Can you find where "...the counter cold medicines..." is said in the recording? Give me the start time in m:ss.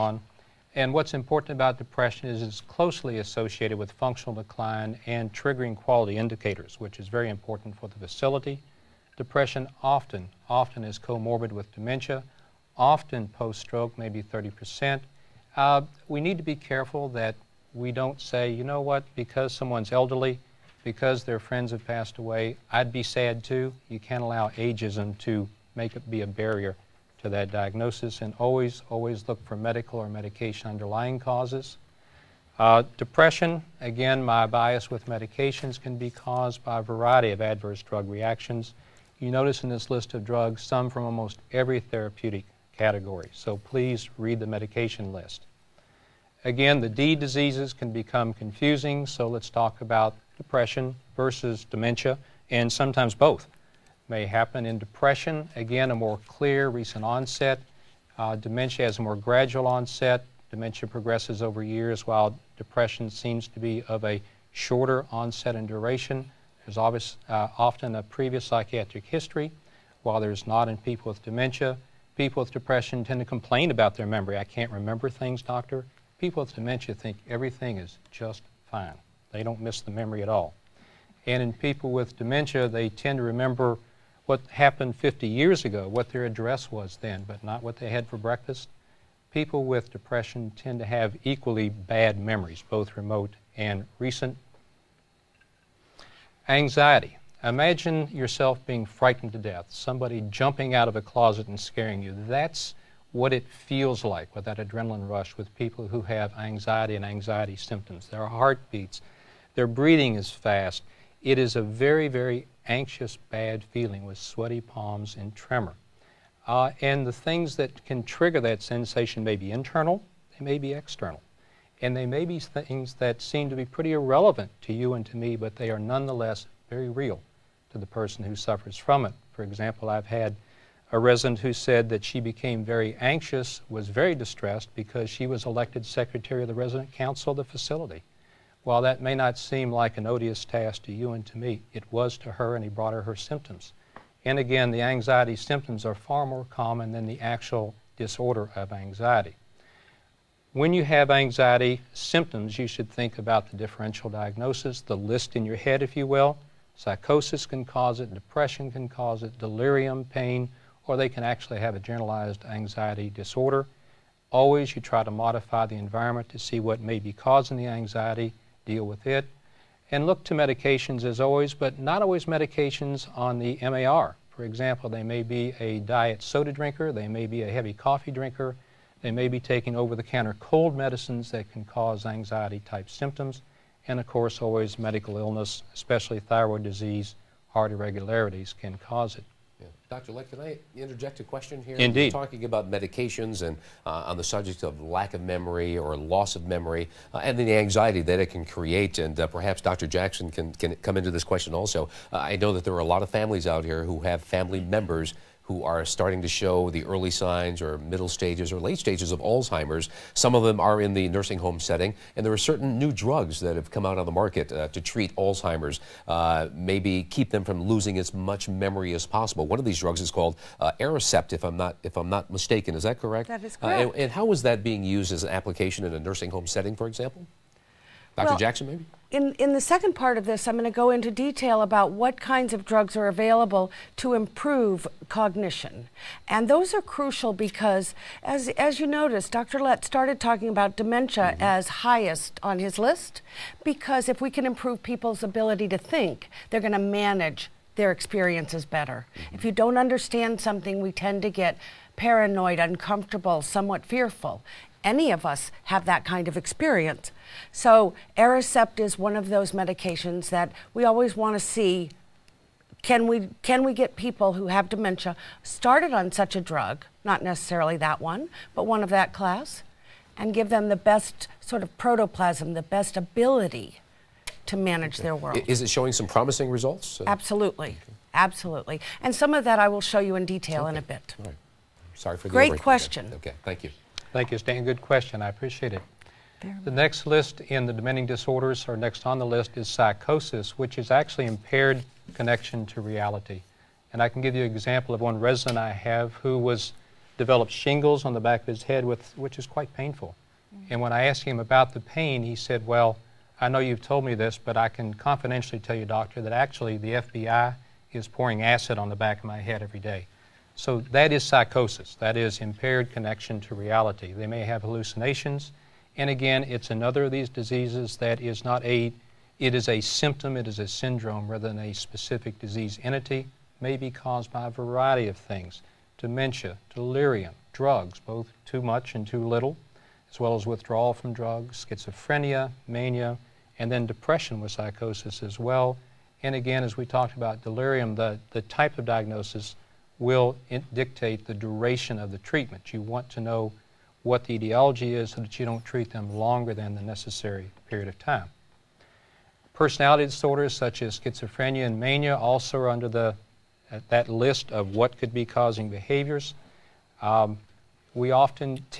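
2:59.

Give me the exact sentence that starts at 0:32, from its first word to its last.
Uh, depression, again, my bias with medications can be caused by a variety of adverse drug reactions.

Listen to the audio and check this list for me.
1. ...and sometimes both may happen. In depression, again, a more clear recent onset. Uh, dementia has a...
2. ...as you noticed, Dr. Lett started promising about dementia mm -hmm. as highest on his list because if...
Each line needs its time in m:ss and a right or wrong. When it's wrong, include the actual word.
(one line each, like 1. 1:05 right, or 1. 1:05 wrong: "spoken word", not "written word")
1. 0:52 right
2. 3:58 wrong: "talking", not "promising".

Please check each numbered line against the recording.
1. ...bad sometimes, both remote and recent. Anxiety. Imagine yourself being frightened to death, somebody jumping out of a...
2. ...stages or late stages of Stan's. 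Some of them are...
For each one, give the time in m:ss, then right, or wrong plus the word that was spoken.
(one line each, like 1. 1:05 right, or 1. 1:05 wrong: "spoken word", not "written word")
1. 1:31 wrong: "memories", not "sometimes"
2. 3:28 wrong: "Alzheimer", not "Stan".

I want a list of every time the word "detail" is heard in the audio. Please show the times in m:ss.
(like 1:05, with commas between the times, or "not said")
3:51, 4:40.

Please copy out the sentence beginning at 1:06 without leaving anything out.
There's obvious, uh, often a previous psychiatric history, while there's not in people with dementia.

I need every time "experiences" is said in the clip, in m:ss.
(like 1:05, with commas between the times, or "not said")
4:07, 4:16.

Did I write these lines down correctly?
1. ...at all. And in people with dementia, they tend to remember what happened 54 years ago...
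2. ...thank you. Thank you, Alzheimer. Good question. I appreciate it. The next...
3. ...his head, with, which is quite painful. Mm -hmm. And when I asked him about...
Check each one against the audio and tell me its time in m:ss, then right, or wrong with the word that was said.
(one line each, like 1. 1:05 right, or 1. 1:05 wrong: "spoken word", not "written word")
1. 1:20 wrong: "50", not "54"
2. 4:43 wrong: "Stan", not "Alzheimer"
3. 4:58 right.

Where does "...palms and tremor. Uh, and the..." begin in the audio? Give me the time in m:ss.
1:54.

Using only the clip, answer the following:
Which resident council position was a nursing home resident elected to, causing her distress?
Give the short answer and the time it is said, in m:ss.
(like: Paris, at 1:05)
Secretary, at 2:15.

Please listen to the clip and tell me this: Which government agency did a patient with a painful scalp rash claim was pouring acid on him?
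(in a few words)
FBI.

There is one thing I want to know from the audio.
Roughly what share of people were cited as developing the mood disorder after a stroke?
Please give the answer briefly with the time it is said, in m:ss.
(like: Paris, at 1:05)
30%, at 0:14.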